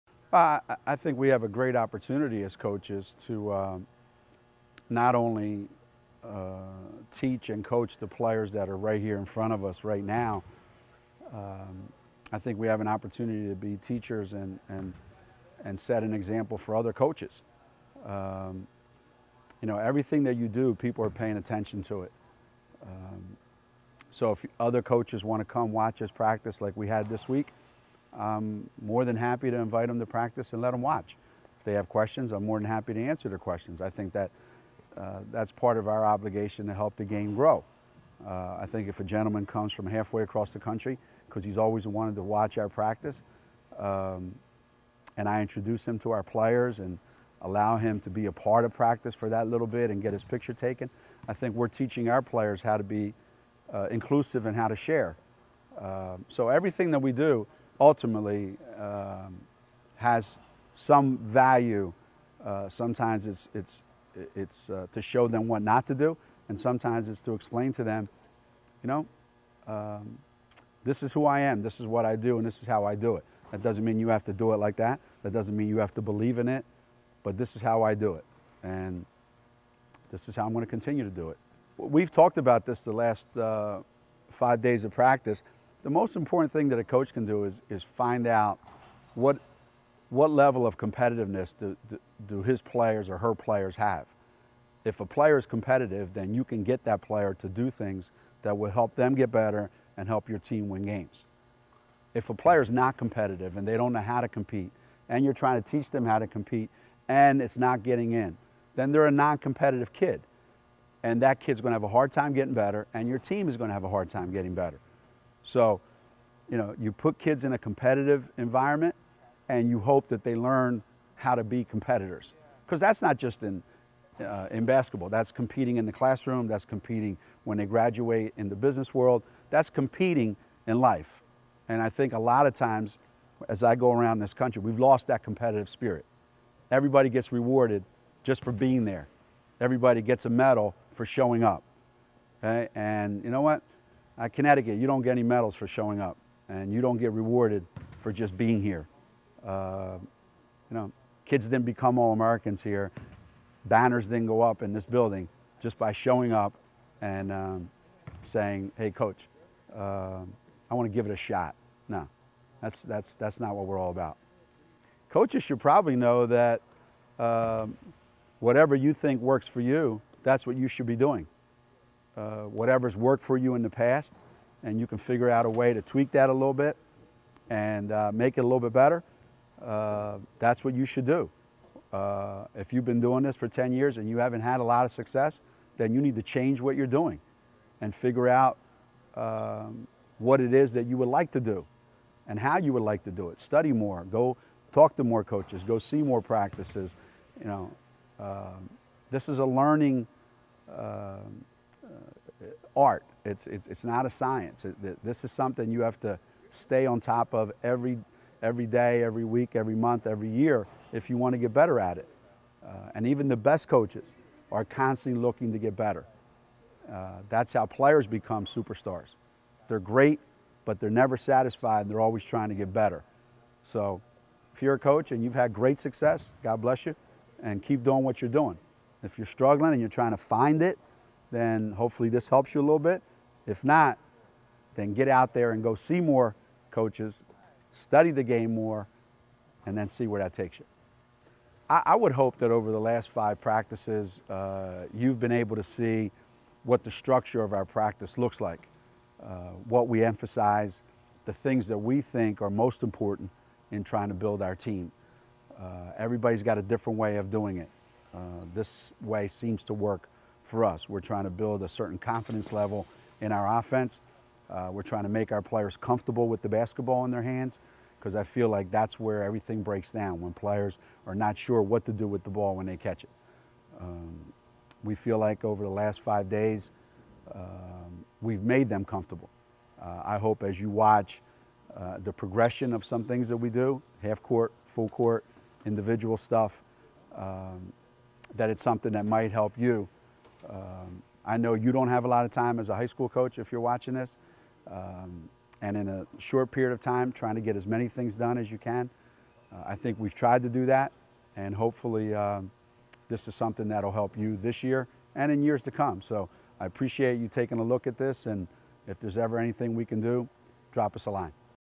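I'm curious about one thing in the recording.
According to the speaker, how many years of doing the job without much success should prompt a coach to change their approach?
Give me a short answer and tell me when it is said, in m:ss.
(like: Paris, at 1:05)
10, at 3:03.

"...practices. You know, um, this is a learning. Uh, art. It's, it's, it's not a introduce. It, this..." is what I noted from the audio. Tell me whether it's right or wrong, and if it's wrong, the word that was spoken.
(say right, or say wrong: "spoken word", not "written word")
wrong: "science", not "introduce".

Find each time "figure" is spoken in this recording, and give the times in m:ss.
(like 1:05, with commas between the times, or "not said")
2:54, 3:07.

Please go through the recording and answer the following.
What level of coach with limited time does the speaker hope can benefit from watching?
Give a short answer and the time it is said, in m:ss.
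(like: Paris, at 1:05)
high school, at 4:52.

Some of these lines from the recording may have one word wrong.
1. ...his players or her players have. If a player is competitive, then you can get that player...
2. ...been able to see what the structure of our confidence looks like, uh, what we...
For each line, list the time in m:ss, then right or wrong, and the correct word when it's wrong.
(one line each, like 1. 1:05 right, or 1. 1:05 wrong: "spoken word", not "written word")
1. 1:32 right
2. 4:05 wrong: "practice", not "confidence".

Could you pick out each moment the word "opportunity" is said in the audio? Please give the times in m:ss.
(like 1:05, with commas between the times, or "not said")
0:01, 0:12.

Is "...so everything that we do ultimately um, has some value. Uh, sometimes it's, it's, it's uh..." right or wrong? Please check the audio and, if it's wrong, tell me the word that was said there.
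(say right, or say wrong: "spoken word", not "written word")
right.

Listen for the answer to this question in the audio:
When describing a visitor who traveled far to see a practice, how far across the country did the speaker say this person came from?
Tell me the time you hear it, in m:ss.
0:39.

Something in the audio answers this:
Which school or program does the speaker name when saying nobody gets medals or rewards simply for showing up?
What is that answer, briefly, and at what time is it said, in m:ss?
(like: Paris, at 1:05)
Connecticut, at 2:24.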